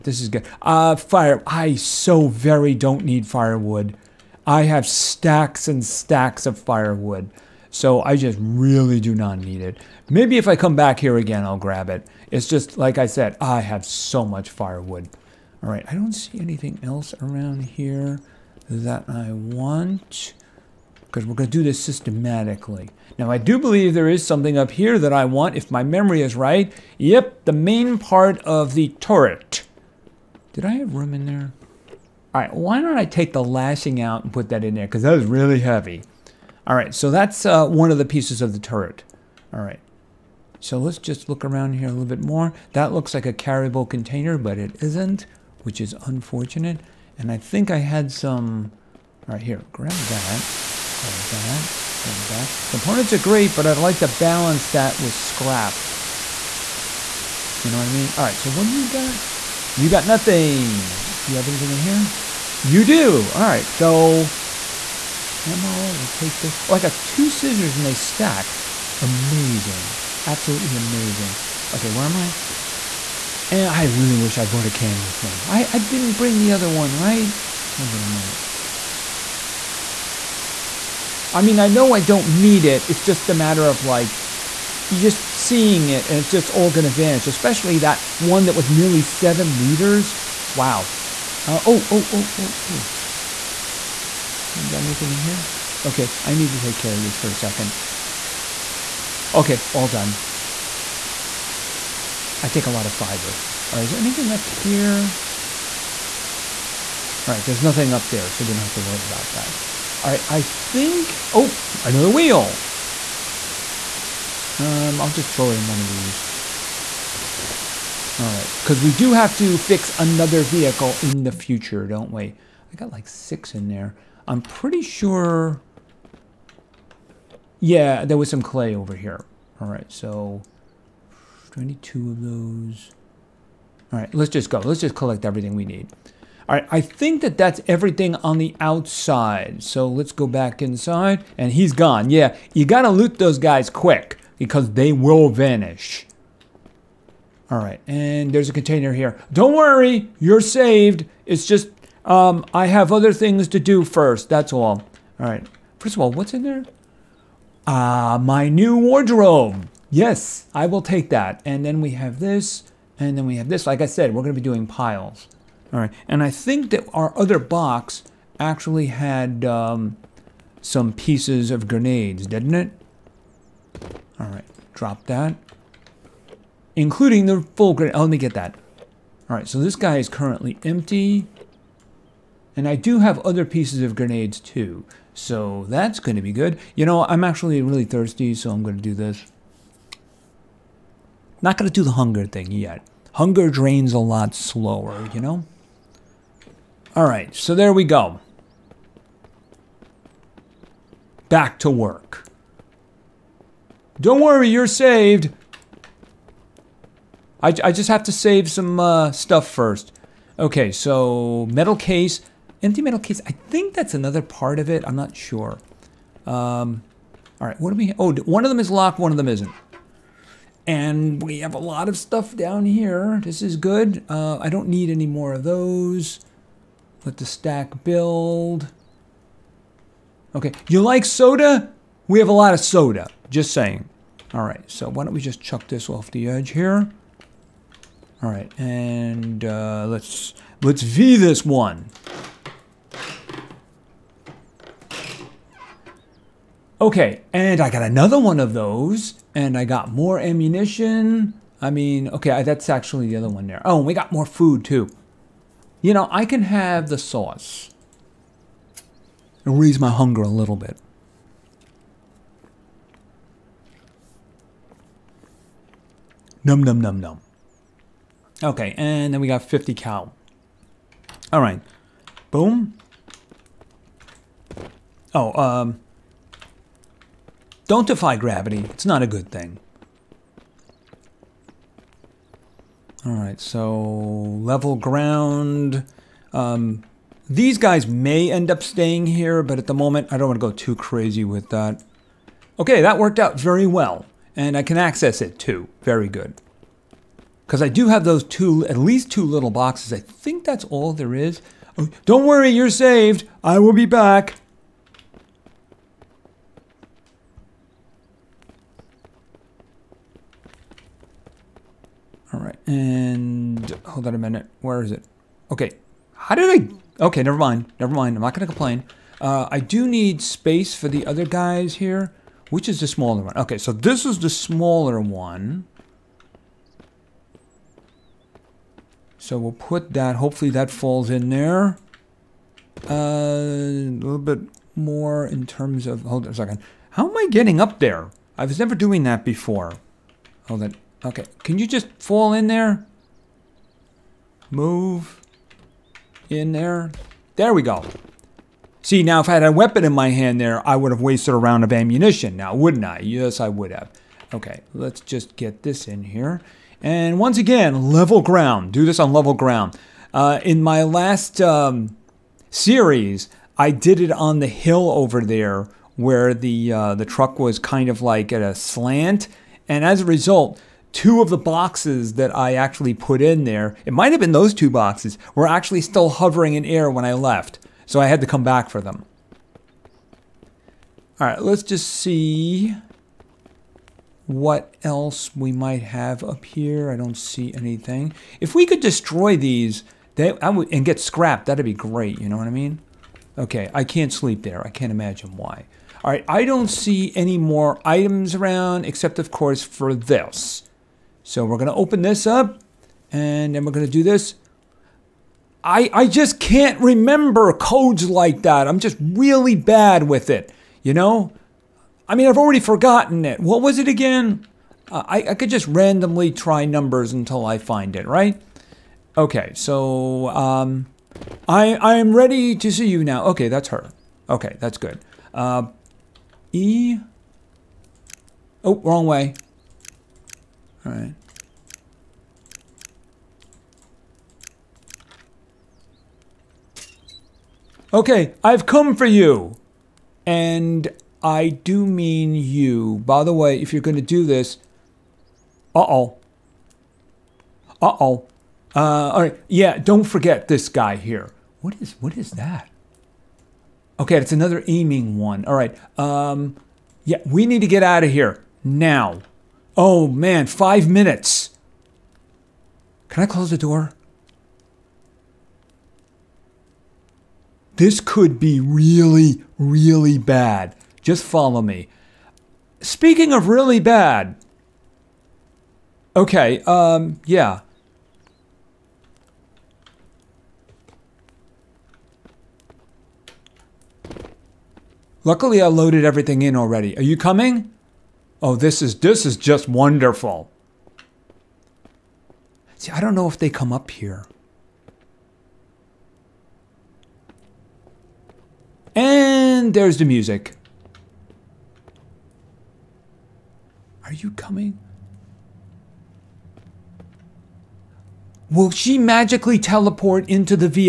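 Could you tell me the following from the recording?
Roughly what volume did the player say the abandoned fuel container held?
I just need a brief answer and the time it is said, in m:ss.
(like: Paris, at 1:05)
nearly 7 liters, at 1:28.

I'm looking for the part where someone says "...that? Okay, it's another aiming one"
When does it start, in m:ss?
7:32.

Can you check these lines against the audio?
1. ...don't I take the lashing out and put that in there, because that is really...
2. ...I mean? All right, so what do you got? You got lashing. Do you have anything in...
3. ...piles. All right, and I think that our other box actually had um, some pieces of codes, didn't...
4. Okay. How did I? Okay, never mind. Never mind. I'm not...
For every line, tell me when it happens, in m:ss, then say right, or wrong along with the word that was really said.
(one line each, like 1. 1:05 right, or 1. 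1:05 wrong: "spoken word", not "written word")
1. 0:32 right
2. 0:57 wrong: "nothing", not "lashing"
3. 2:44 wrong: "grenades", not "codes"
4. 5:15 right.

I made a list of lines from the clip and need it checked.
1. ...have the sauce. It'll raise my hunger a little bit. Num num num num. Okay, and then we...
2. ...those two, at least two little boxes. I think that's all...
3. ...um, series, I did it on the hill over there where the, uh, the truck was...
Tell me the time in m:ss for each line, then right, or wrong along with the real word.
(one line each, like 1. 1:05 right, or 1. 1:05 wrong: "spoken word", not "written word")
1. 4:16 right
2. 4:58 right
3. 6:01 right.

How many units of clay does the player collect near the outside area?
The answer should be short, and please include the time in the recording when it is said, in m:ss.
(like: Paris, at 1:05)
22, at 2:11.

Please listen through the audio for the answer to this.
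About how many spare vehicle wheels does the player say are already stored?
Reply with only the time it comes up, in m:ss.
2:03.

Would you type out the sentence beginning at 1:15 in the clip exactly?
I, I didn't bring the other one, right?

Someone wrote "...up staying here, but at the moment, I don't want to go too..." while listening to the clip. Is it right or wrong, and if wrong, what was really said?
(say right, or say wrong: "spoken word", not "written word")
right.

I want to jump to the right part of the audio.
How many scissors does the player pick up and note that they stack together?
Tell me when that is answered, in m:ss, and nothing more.
1:07.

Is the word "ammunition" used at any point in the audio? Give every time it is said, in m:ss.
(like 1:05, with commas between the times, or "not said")
4:10, 5:51.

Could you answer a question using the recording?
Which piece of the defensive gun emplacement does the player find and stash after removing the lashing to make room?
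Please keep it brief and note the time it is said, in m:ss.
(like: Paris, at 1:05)
main part of the turret, at 0:27.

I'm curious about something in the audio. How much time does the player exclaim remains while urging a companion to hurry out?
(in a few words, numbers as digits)
5 minutes.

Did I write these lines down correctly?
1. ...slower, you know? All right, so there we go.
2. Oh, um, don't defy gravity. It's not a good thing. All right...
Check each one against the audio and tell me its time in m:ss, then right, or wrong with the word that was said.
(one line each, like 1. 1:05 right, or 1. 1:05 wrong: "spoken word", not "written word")
1. 3:14 right
2. 4:35 right.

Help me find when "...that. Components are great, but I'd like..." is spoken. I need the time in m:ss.
0:52.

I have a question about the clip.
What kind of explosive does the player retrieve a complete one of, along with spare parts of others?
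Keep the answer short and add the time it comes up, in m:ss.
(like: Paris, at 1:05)
grenade, at 2:57.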